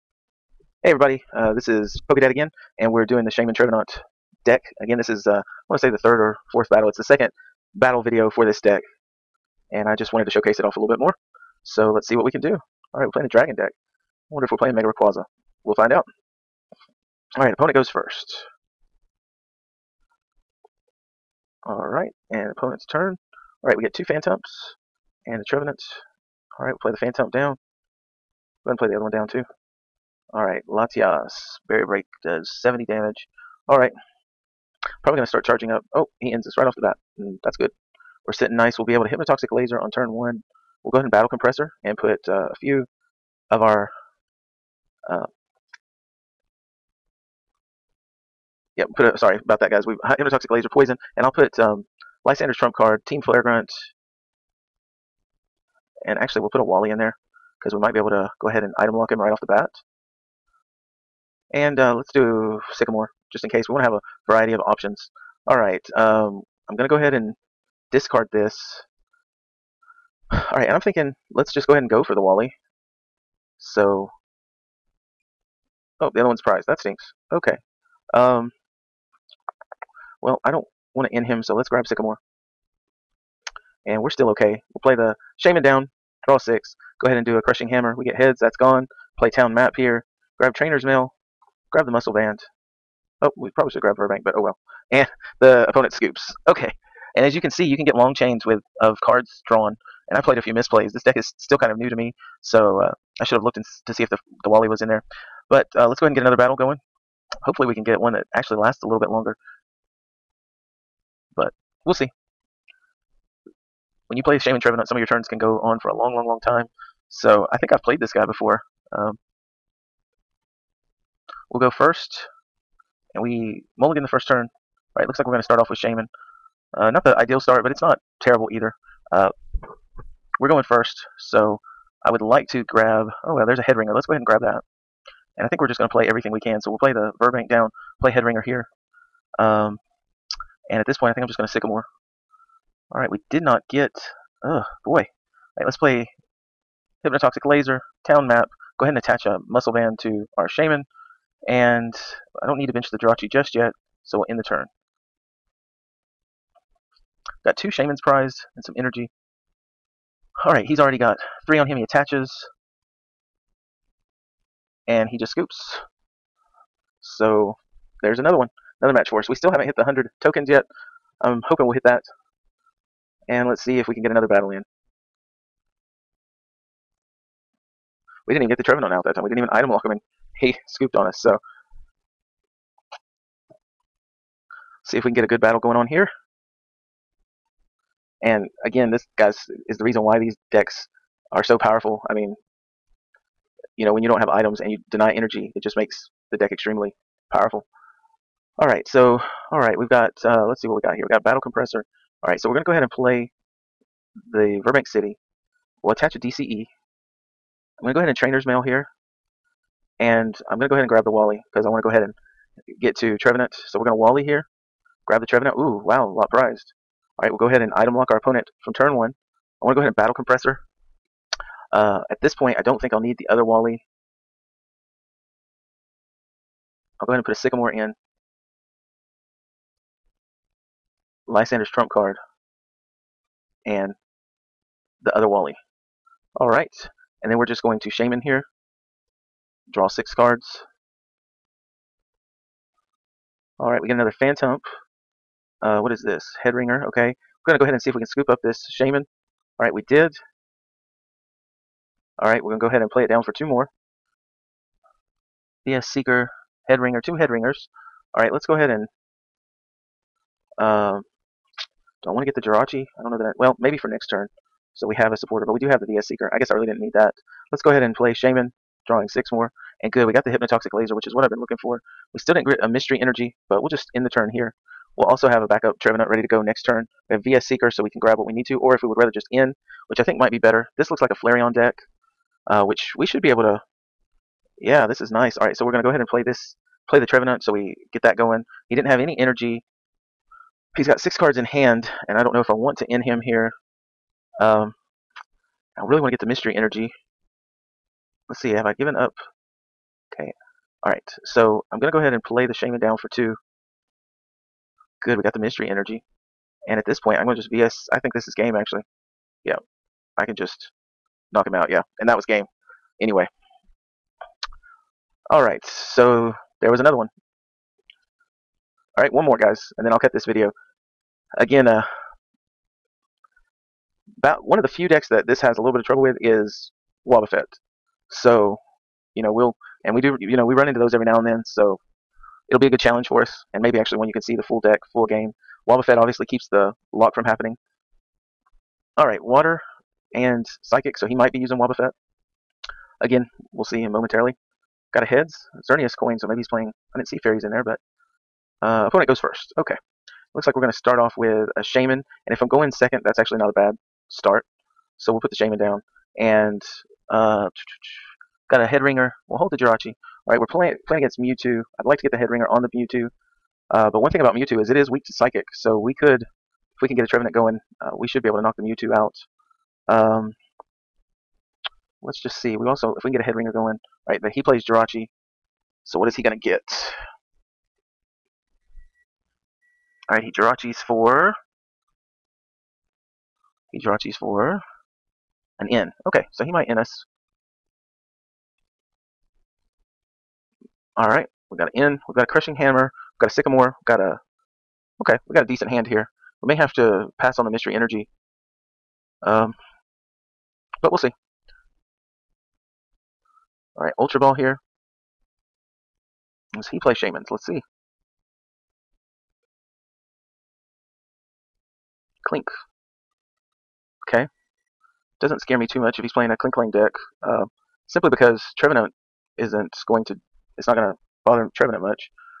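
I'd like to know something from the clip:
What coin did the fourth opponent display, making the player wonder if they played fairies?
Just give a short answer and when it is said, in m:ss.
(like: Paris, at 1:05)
Xerneas coin, at 5:45.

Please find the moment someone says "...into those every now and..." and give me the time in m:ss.
5:30.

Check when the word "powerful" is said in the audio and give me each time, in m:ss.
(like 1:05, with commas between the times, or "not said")
3:11, 3:17.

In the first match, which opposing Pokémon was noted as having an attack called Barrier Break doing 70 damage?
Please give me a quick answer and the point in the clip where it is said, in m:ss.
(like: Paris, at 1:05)
Latias, at 0:30.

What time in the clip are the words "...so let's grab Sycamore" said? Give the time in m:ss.
1:21.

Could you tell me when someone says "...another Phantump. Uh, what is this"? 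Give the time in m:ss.
4:03.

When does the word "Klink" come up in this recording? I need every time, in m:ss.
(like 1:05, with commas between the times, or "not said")
6:52, 6:56.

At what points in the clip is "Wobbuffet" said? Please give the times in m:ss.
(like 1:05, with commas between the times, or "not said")
5:27, 5:35, 5:41.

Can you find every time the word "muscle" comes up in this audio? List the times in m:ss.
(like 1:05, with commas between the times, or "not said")
1:31, 2:29.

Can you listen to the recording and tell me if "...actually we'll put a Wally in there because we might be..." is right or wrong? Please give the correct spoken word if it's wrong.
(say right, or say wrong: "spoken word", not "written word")
right.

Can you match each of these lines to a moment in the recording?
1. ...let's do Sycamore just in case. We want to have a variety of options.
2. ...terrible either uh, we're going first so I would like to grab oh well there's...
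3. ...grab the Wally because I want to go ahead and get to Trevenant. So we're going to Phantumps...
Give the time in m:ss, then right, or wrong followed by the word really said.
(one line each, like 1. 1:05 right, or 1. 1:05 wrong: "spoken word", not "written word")
1. 1:01 right
2. 2:08 right
3. 3:30 wrong: "Wally", not "Phantumps".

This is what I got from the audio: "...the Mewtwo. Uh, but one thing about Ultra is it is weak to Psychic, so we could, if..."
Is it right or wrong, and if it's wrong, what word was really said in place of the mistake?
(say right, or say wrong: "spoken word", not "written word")
wrong: "Mewtwo", not "Ultra".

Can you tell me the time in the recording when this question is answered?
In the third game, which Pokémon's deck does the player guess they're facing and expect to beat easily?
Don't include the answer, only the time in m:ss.
4:41.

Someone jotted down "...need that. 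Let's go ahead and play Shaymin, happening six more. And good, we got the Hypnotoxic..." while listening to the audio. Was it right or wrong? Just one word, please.
wrong.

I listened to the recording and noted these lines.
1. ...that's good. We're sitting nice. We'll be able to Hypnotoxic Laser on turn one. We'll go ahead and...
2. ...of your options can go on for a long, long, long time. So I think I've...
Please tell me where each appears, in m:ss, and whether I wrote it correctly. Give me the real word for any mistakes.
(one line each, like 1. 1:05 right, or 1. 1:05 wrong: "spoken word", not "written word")
1. 0:37 right
2. 1:54 wrong: "turns", not "options".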